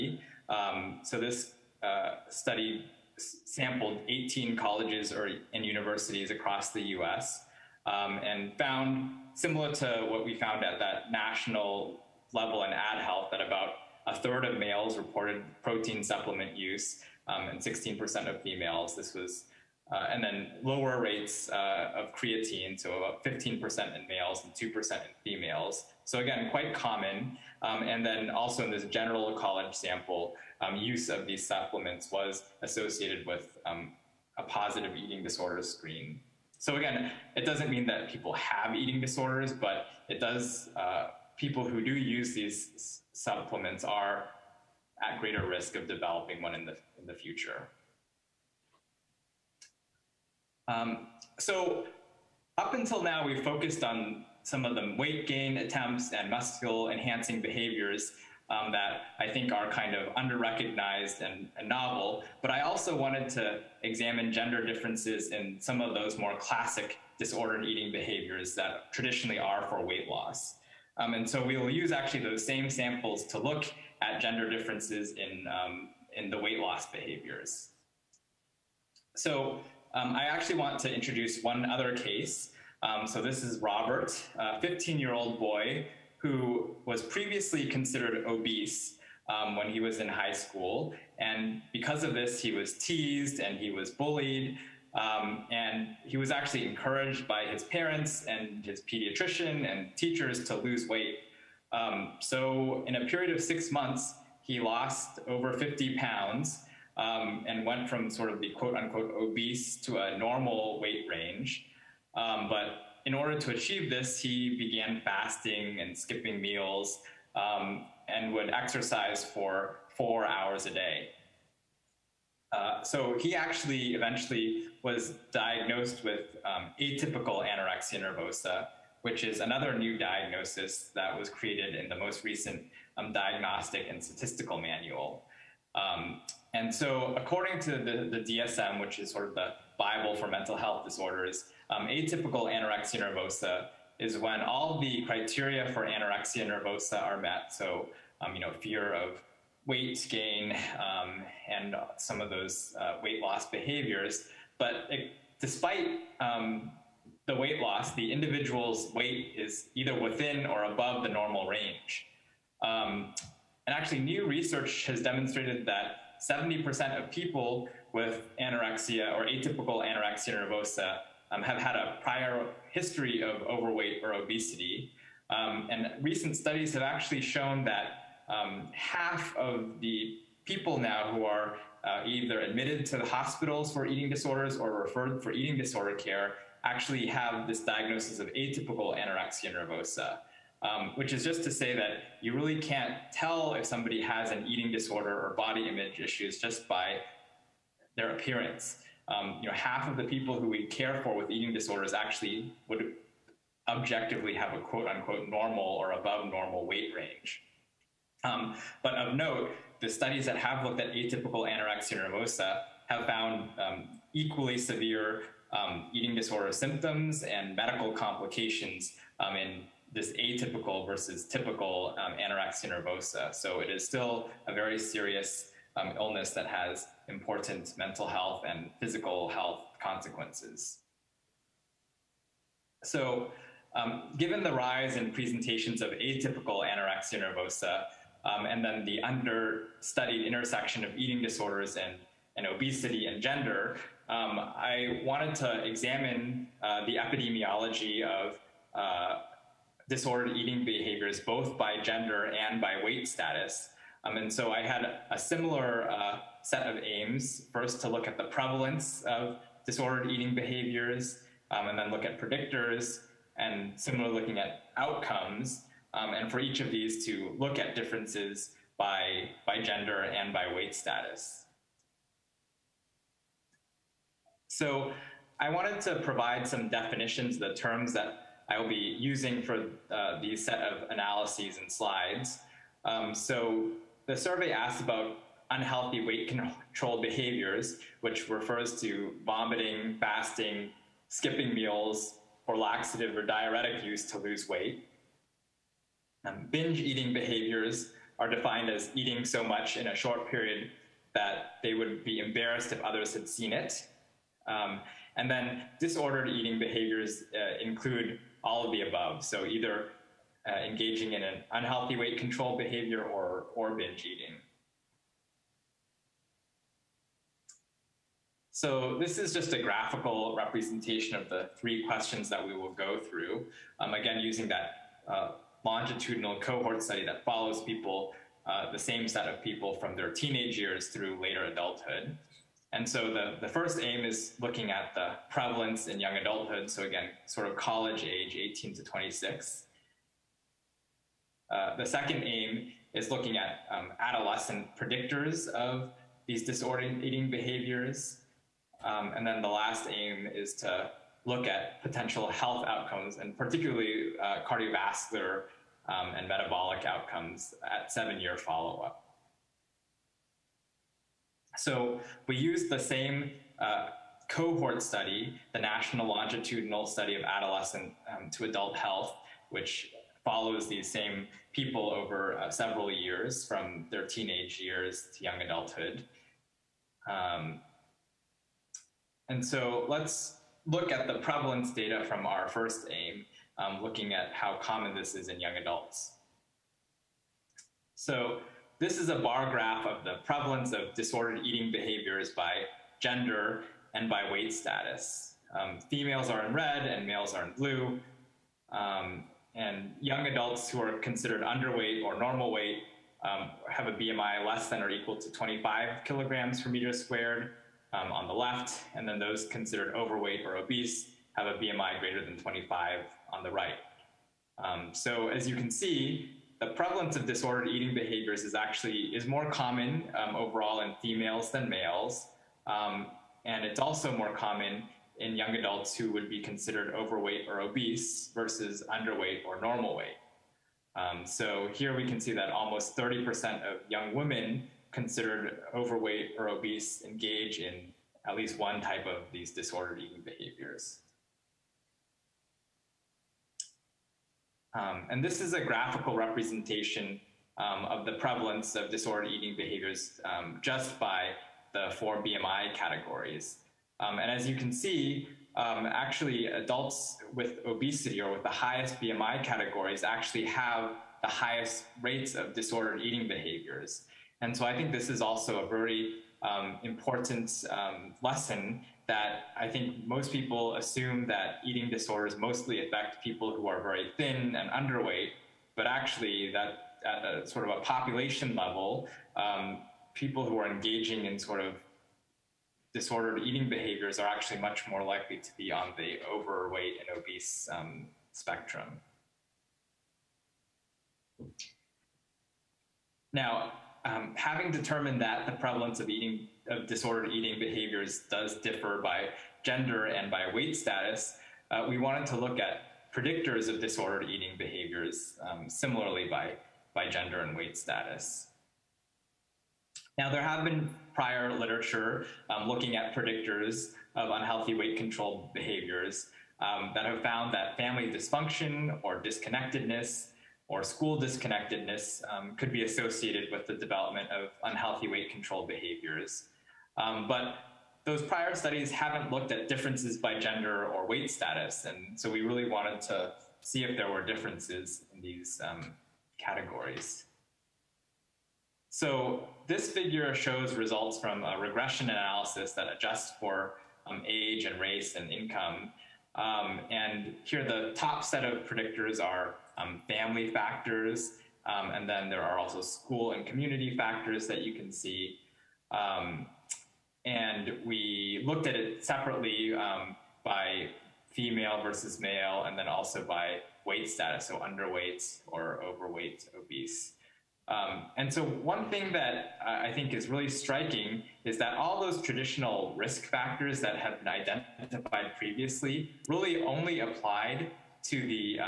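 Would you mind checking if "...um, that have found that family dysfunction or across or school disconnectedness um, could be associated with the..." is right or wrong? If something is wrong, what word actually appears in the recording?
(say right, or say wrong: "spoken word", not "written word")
wrong: "disconnectedness", not "across".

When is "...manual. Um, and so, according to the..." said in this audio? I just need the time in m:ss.
2:14.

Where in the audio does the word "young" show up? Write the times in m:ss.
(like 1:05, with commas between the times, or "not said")
5:36, 6:15, 6:25, 6:40, 7:05, 7:13.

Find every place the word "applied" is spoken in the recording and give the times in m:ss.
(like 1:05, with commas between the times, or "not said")
9:37.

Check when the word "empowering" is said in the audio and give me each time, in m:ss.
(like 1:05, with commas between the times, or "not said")
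not said.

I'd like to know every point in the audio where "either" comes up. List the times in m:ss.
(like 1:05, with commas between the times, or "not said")
2:39, 3:02, 5:09.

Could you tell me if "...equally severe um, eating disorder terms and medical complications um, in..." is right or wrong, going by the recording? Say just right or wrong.
wrong.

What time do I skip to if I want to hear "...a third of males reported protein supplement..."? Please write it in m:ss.
0:14.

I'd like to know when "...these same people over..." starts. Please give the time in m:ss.
6:10.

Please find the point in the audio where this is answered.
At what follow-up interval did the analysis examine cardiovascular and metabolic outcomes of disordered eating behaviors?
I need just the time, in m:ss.
5:57.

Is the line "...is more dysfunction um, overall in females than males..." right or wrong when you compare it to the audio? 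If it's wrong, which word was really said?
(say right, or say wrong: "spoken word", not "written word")
wrong: "common", not "dysfunction".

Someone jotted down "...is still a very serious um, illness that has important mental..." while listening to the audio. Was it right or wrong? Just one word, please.
right.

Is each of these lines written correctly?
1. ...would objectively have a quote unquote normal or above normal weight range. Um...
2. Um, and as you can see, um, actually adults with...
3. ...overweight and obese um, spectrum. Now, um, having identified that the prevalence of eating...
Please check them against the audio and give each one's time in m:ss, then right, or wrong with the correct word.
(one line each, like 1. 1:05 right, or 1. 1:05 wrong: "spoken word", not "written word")
1. 3:22 right
2. 7:34 right
3. 8:06 wrong: "determined", not "identified".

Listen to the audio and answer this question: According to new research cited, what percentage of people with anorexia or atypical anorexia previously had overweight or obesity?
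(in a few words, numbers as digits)
70%.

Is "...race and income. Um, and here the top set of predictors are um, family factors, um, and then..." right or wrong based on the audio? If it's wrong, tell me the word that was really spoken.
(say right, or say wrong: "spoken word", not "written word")
right.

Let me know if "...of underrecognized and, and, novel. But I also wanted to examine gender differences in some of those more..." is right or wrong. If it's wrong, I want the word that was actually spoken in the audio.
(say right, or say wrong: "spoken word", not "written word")
right.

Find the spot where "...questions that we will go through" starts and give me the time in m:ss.
5:21.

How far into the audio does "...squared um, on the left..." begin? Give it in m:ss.
6:46.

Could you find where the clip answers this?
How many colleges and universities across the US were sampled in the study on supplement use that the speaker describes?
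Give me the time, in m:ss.
0:04.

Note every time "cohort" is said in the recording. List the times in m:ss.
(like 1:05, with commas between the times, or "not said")
5:26, 6:04.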